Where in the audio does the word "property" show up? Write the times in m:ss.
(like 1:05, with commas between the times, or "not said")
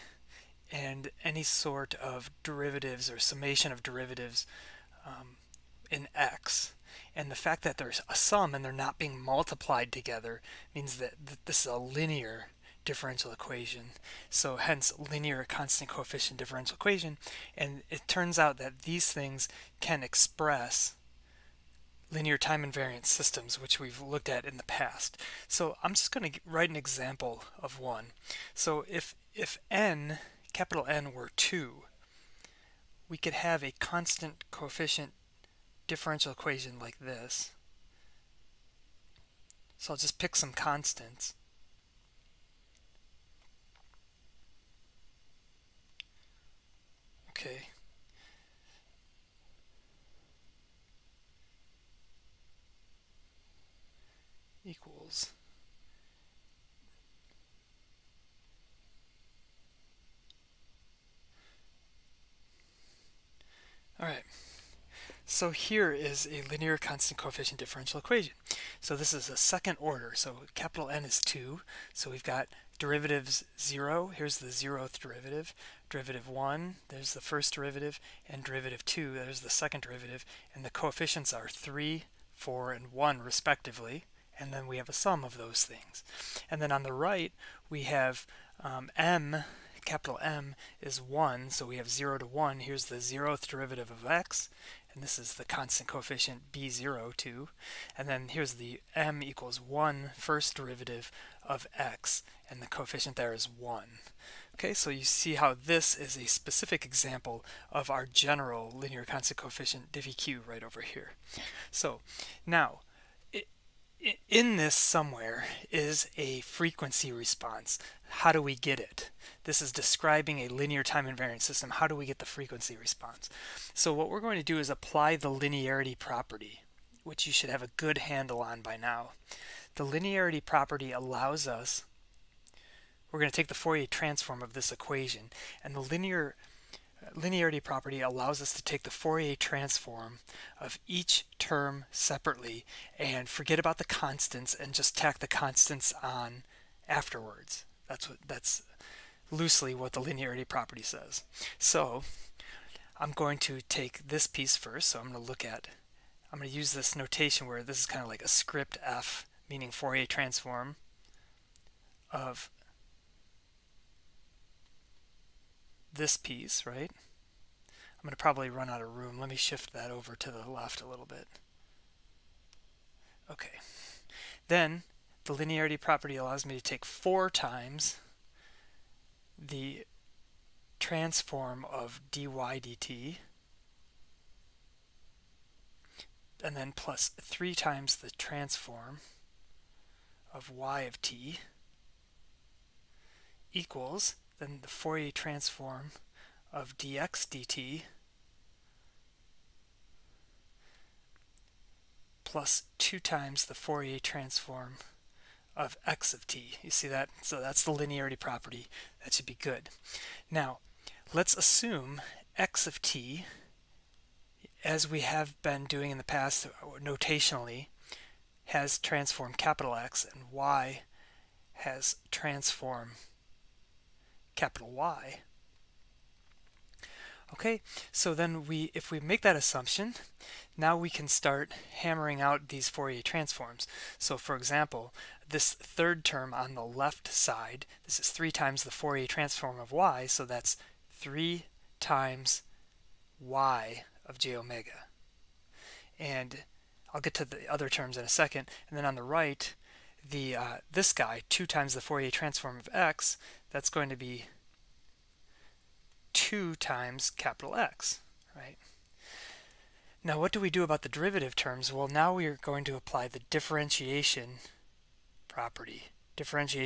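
2:05, 2:10, 2:17, 2:30, 2:55, 3:28, 4:25.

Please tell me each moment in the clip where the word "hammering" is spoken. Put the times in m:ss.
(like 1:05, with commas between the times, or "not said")
3:51.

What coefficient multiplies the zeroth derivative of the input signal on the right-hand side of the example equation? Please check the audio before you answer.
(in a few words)
2.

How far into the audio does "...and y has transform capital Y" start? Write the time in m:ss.
3:40.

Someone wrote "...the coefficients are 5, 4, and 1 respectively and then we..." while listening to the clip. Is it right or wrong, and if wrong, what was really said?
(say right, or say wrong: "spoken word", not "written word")
wrong: "3", not "5".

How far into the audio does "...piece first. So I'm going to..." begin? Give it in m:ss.
2:34.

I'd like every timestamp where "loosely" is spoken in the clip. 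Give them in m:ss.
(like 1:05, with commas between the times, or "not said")
2:29.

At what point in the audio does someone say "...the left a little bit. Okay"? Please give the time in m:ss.
2:50.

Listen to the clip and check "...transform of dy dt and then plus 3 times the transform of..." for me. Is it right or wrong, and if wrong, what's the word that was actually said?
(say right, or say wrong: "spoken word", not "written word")
right.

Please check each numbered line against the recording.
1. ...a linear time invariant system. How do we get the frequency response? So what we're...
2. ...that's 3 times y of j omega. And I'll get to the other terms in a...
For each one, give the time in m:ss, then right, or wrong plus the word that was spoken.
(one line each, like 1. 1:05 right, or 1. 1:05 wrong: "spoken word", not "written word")
1. 2:00 right
2. 4:00 right.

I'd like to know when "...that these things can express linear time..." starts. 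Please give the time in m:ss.
0:18.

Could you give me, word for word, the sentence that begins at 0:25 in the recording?
So I'm just going to write an example of one.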